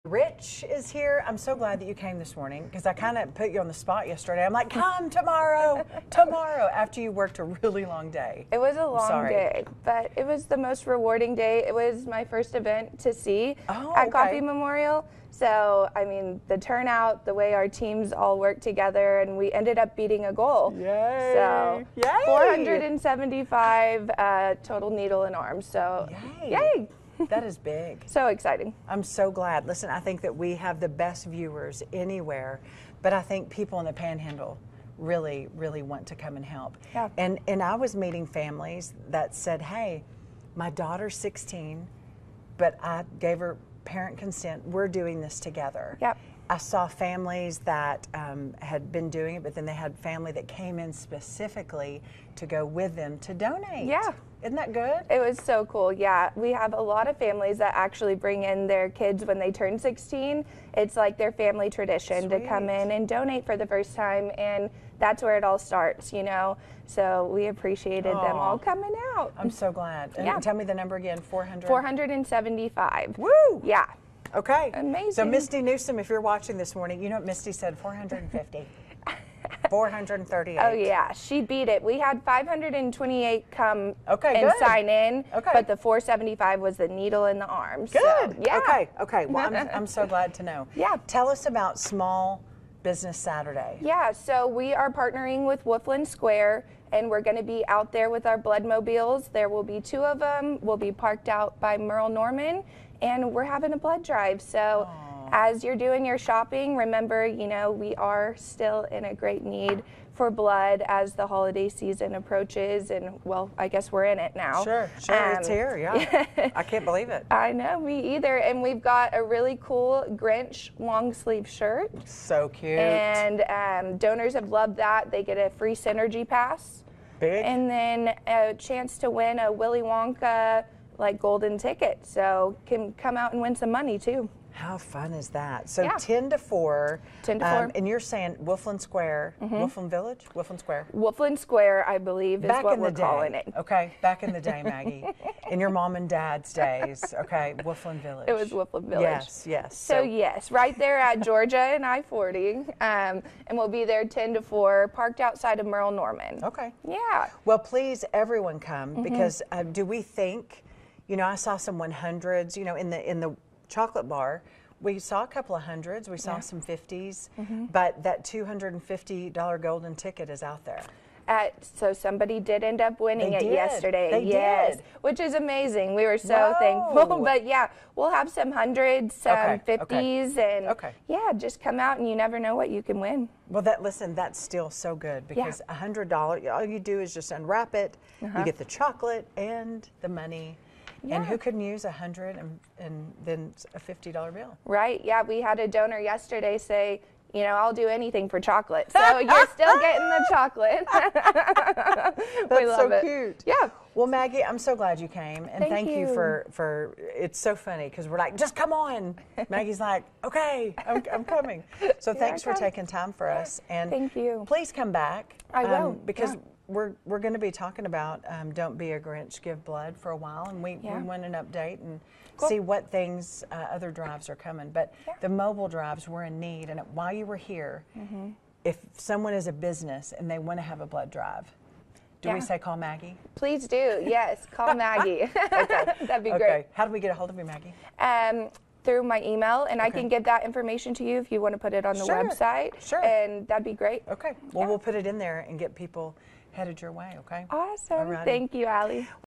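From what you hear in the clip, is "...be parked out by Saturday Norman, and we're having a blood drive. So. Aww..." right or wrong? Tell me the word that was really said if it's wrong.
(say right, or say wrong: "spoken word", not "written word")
wrong: "Merle", not "Saturday".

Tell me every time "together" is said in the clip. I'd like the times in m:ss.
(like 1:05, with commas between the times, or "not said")
0:18, 0:45.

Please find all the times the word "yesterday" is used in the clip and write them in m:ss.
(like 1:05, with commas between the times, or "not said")
0:04, 2:53, 3:15.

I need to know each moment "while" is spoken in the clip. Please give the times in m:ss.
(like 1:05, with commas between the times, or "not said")
3:40, 3:46.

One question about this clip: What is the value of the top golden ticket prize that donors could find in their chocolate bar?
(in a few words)
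$250.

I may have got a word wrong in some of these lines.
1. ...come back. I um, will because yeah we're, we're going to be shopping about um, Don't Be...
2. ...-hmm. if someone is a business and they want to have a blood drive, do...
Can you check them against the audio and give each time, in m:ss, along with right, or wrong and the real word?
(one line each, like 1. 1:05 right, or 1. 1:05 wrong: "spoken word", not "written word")
1. 3:34 wrong: "talking", not "shopping"
2. 3:48 right.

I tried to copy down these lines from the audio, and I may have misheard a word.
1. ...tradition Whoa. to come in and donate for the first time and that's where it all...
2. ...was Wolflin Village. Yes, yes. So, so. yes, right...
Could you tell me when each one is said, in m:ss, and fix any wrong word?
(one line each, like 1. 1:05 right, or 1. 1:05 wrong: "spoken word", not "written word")
1. 1:01 wrong: "Sweet", not "Whoa"
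2. 2:28 right.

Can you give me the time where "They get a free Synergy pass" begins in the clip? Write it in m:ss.
2:05.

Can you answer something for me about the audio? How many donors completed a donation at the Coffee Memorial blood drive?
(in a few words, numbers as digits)
475.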